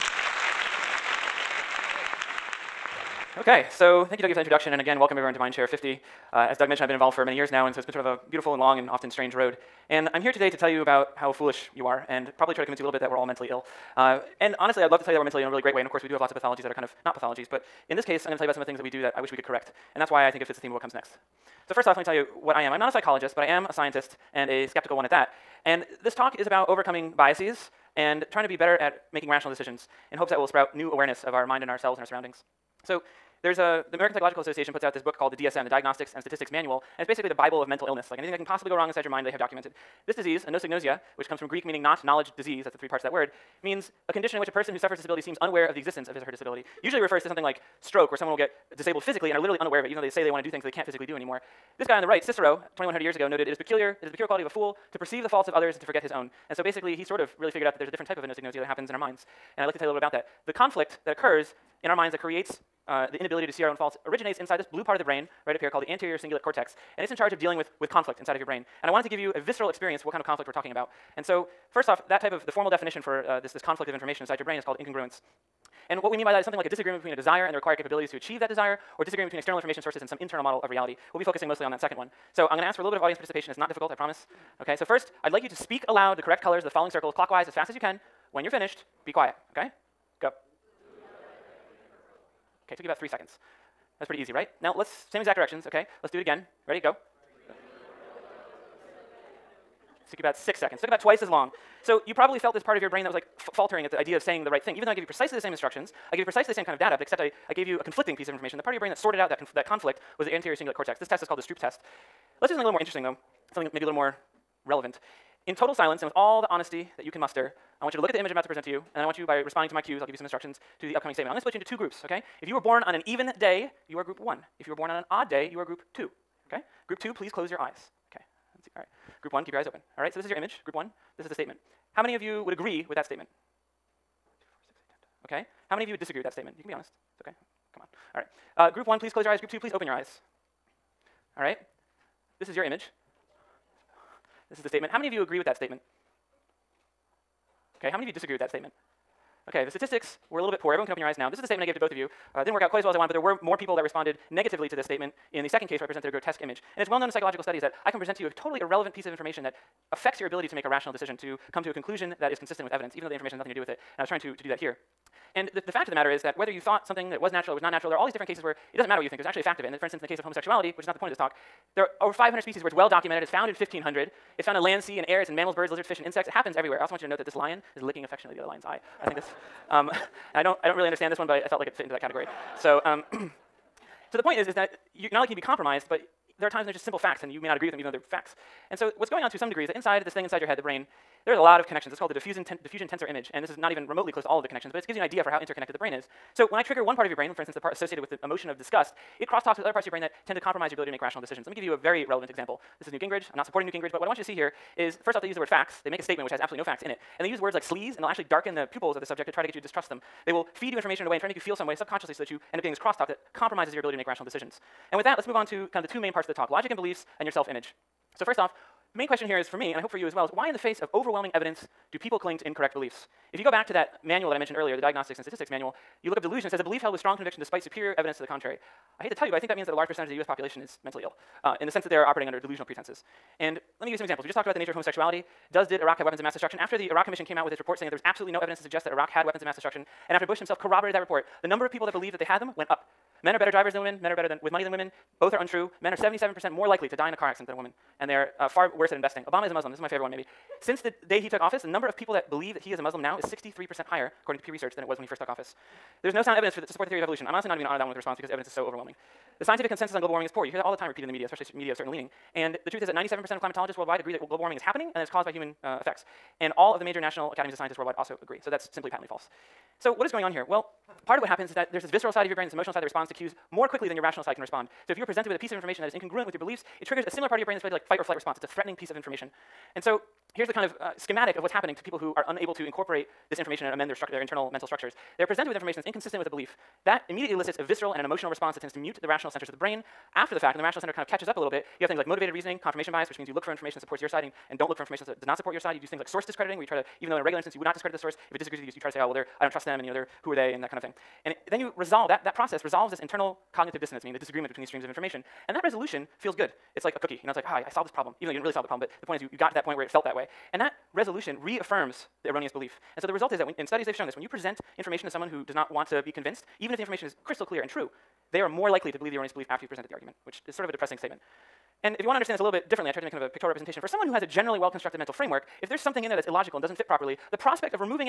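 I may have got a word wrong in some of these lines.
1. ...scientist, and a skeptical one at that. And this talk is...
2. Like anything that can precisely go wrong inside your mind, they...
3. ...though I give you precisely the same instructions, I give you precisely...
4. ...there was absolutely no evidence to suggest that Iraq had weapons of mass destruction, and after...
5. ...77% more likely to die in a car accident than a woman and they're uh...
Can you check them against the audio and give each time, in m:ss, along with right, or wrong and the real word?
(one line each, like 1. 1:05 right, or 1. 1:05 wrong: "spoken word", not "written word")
1. 0:23 right
2. 0:38 wrong: "possibly", not "precisely"
3. 1:44 right
4. 3:57 right
5. 4:05 right.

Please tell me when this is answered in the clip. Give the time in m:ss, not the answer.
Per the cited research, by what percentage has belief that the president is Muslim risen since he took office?
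4:13.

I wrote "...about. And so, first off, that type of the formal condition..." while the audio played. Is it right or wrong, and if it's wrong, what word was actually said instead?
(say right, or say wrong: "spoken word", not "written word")
wrong: "definition", not "condition".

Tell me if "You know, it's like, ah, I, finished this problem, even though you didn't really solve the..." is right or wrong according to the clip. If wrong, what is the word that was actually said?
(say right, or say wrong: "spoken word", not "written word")
wrong: "solved", not "finished".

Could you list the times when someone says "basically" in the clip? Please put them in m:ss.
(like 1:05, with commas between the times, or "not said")
0:37, 0:56.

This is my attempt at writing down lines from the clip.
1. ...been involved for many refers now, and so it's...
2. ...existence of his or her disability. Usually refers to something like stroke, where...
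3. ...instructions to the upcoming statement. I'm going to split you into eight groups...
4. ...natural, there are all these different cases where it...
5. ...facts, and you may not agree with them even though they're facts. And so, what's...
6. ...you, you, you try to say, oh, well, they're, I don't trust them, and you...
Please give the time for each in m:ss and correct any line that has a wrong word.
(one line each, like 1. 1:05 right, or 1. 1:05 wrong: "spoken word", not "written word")
1. 0:06 wrong: "years", not "refers"
2. 0:45 right
3. 2:00 wrong: "two", not "eight"
4. 2:47 right
5. 3:06 right
6. 4:58 right.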